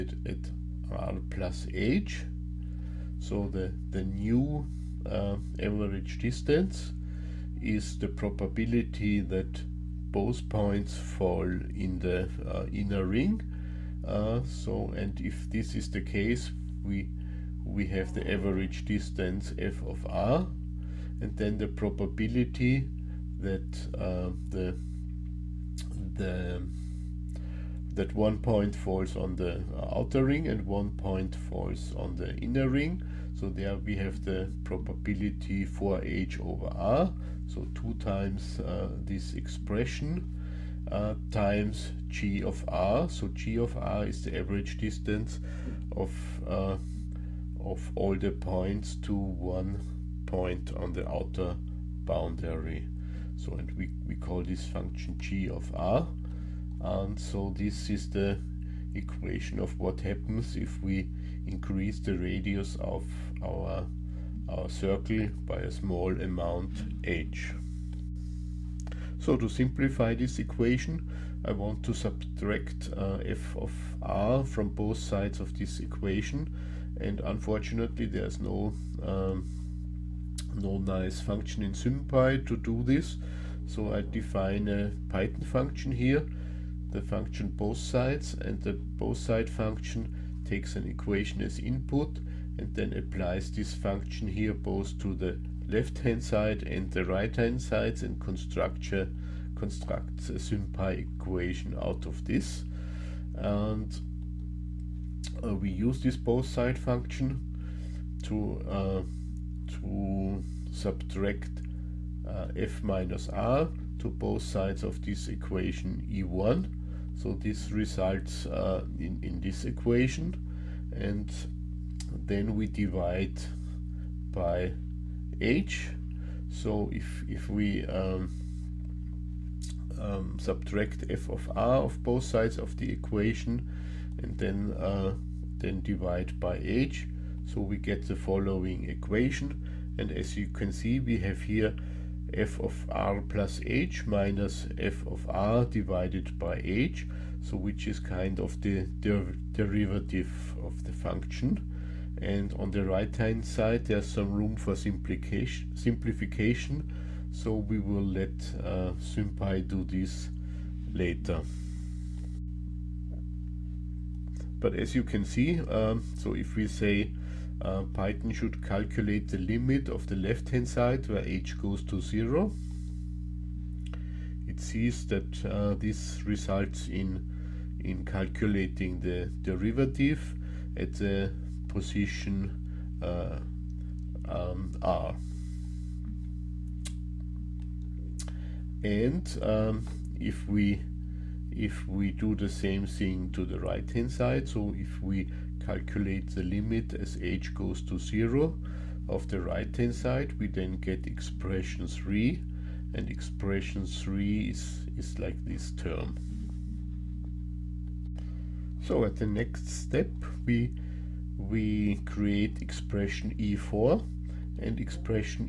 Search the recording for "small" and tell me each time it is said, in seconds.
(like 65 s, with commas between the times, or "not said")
65 s.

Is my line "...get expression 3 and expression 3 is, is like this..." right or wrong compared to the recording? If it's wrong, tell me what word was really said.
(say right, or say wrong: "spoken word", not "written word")
right.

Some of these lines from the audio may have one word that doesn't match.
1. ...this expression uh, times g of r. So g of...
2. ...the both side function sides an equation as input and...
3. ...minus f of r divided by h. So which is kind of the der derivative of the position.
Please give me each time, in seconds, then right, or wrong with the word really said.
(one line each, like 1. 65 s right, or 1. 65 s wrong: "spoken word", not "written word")
1. 39 s right
2. 88 s wrong: "takes", not "sides"
3. 144 s wrong: "function", not "position".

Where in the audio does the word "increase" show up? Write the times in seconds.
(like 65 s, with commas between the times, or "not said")
61 s.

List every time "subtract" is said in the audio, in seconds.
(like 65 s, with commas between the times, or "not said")
71 s, 110 s, 130 s.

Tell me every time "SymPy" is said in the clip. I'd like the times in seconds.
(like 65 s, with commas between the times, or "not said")
81 s, 100 s, 158 s.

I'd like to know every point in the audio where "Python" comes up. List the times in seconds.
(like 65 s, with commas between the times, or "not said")
85 s, 167 s.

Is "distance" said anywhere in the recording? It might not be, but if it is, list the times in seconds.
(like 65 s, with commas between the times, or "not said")
6 s, 18 s, 44 s.